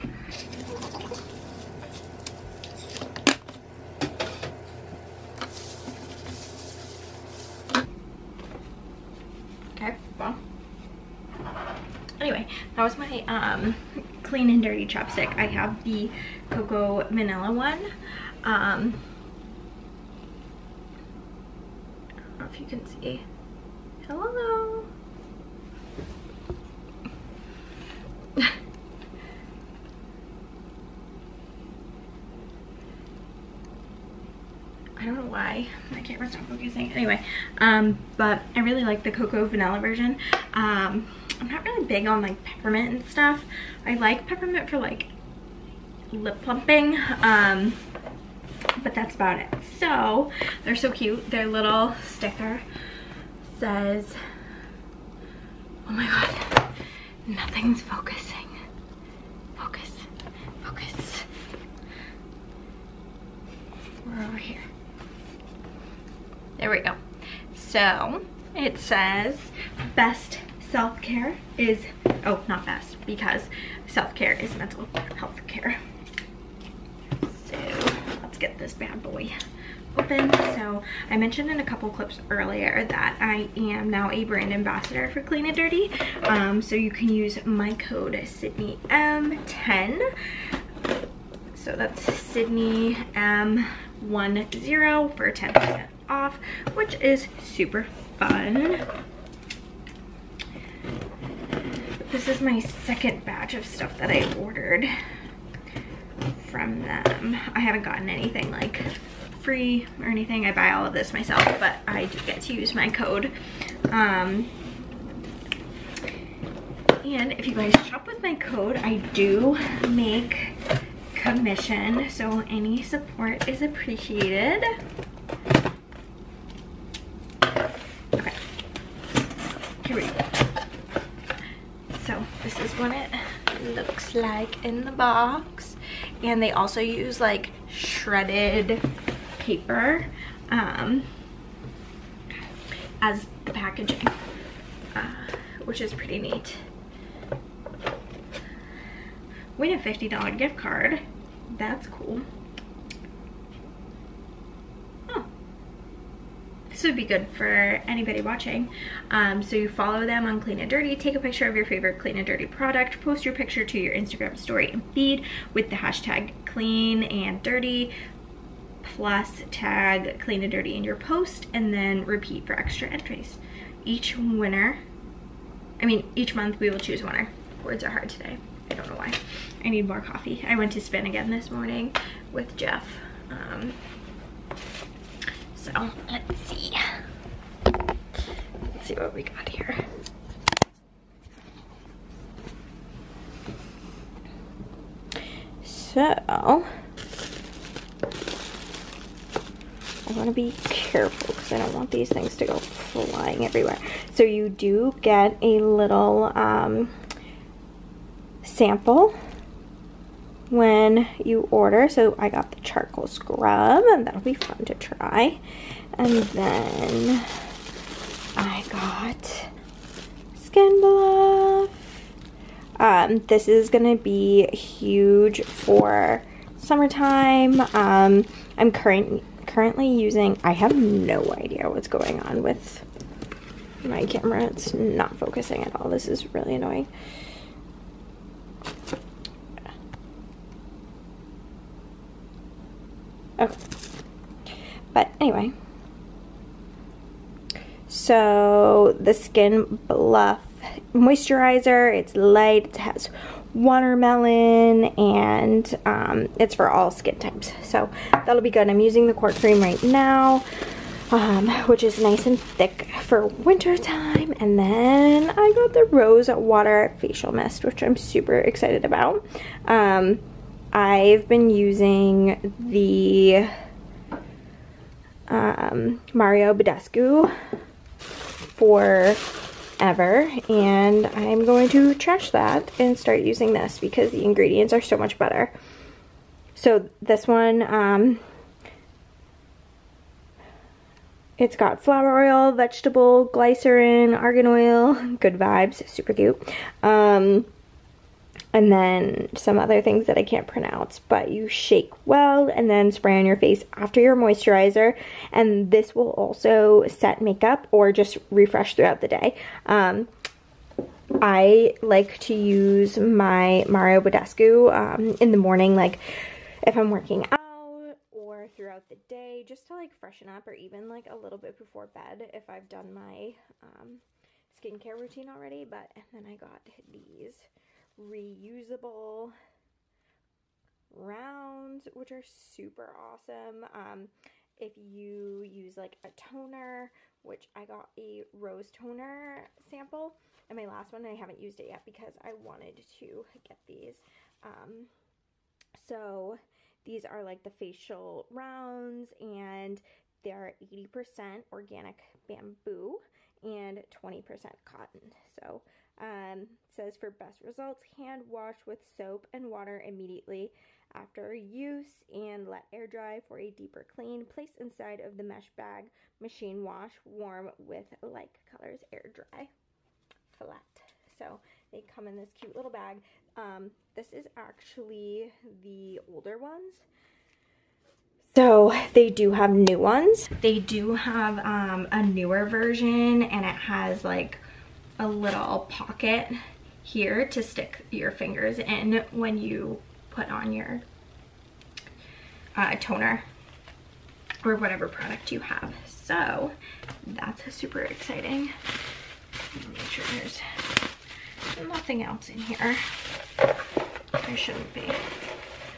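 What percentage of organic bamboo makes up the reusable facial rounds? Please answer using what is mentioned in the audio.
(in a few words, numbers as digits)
80%.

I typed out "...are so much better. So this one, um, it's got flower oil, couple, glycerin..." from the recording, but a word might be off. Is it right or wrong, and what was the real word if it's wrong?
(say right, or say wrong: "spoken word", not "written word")
wrong: "vegetable", not "couple".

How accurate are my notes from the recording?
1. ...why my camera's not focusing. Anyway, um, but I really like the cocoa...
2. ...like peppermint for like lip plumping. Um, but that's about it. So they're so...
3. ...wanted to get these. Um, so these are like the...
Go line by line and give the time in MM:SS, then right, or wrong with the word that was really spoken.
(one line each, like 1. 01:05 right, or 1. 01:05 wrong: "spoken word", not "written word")
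1. 00:35 right
2. 00:43 right
3. 05:42 right.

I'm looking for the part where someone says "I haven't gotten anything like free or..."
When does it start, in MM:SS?
01:47.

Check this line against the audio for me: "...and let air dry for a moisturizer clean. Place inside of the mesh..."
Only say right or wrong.
wrong.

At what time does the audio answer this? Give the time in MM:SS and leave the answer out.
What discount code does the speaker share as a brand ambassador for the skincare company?
01:28.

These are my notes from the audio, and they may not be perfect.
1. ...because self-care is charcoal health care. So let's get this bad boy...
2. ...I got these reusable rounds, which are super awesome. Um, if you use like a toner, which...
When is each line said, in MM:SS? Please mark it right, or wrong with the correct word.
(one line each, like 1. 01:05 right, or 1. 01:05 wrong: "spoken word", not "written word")
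1. 01:13 wrong: "mental", not "charcoal"
2. 05:26 right.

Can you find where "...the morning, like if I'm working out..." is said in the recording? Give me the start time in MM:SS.
05:15.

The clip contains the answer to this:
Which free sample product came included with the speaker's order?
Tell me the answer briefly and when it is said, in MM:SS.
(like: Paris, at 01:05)
charcoal scrub, at 03:32.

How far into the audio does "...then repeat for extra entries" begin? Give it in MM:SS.
02:51.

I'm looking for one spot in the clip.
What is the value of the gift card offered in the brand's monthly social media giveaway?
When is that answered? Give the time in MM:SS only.
02:29.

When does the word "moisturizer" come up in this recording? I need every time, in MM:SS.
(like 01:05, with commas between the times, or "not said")
04:10, 05:04.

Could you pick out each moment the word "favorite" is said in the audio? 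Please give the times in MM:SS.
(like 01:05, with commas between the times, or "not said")
02:41.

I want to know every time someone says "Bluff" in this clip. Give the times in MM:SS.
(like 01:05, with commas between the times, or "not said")
03:40, 04:09.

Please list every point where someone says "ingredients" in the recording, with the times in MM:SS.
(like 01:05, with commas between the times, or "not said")
04:44.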